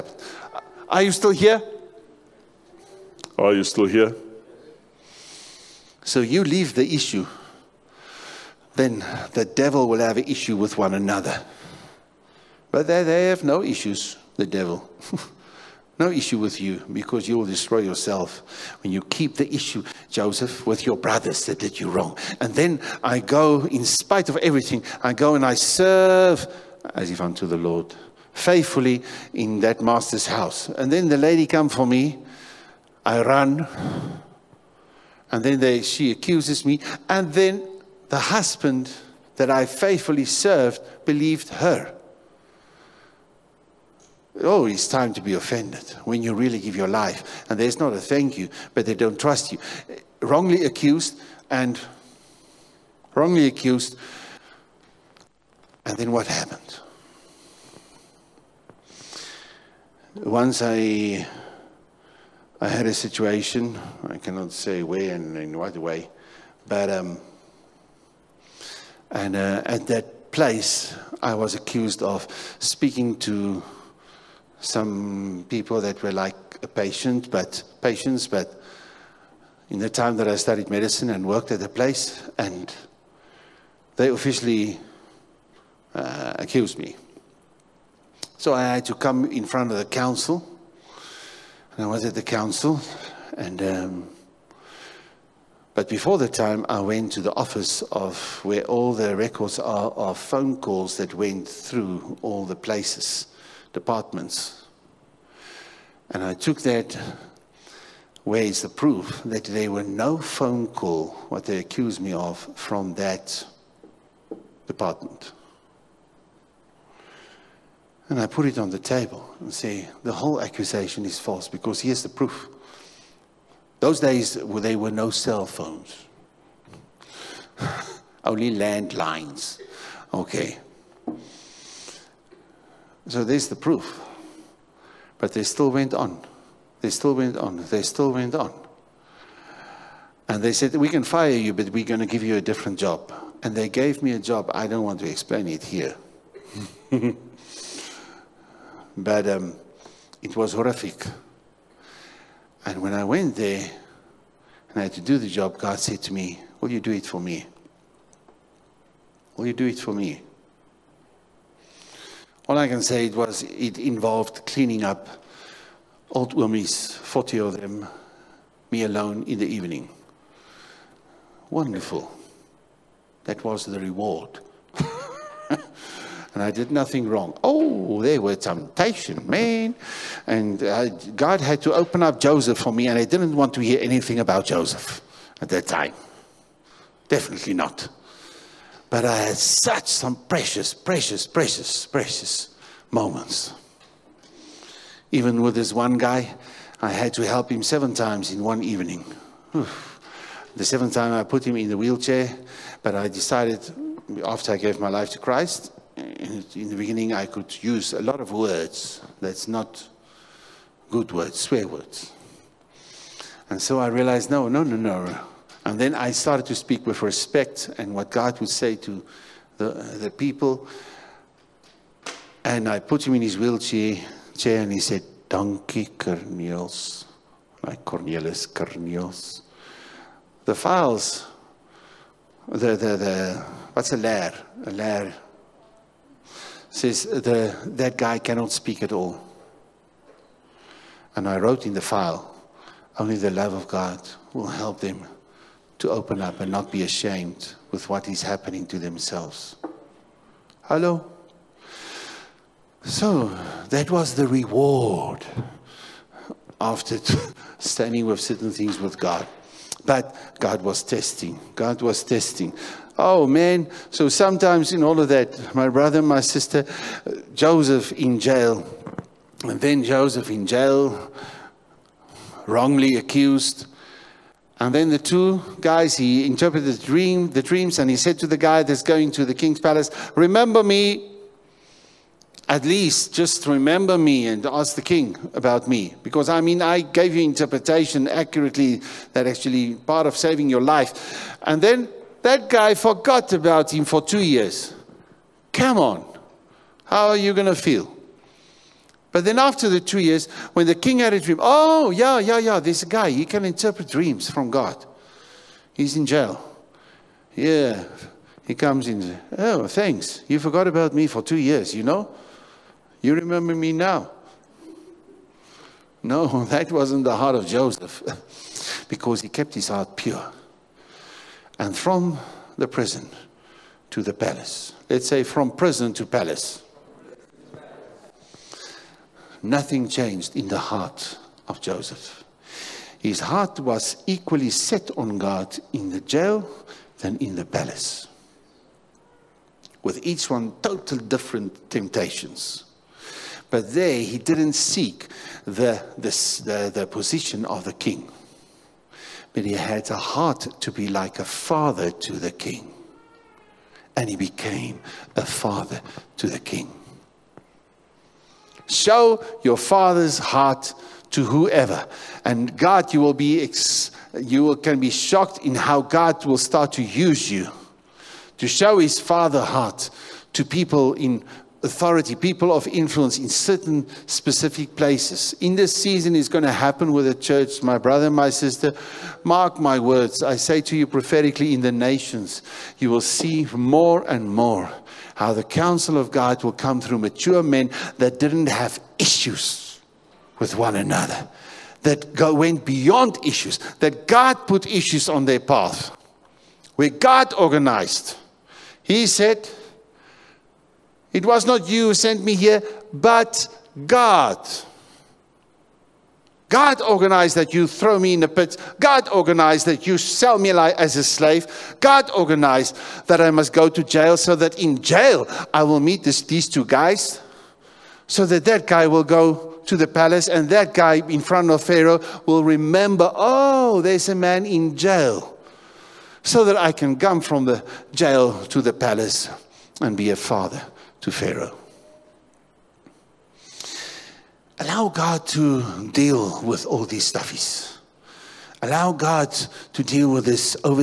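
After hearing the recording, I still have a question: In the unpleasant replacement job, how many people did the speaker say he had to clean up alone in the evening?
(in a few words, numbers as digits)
40.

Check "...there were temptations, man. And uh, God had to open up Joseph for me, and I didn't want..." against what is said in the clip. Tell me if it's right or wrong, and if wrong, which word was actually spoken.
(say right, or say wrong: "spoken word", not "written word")
right.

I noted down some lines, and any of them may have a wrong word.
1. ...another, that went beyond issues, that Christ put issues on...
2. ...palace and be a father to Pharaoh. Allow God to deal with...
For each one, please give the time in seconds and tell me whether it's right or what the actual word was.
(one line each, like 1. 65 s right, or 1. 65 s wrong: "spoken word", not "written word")
1. 390 s wrong: "God", not "Christ"
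2. 428 s right.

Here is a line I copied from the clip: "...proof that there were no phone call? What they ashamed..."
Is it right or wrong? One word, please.
wrong.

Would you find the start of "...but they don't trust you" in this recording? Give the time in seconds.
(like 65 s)
48 s.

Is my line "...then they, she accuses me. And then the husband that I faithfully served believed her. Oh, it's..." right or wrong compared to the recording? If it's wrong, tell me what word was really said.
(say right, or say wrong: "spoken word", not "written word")
right.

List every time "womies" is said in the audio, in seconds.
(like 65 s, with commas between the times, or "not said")
166 s.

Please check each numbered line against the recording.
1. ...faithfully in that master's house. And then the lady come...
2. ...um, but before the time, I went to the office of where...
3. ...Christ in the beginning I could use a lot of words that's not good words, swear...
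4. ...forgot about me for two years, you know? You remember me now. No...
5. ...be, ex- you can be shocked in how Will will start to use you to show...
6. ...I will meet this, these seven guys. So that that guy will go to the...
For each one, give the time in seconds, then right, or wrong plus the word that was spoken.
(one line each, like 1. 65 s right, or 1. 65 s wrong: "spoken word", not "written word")
1. 28 s right
2. 93 s right
3. 205 s right
4. 310 s right
5. 363 s wrong: "God", not "Will"
6. 415 s wrong: "two", not "seven".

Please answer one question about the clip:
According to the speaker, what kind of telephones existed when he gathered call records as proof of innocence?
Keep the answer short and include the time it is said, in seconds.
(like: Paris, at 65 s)
Landlines, at 128 s.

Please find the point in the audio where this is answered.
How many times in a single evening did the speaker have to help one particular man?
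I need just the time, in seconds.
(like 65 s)
197 s.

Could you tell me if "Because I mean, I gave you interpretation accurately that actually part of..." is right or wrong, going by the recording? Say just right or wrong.
right.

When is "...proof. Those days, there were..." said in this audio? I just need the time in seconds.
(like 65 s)
122 s.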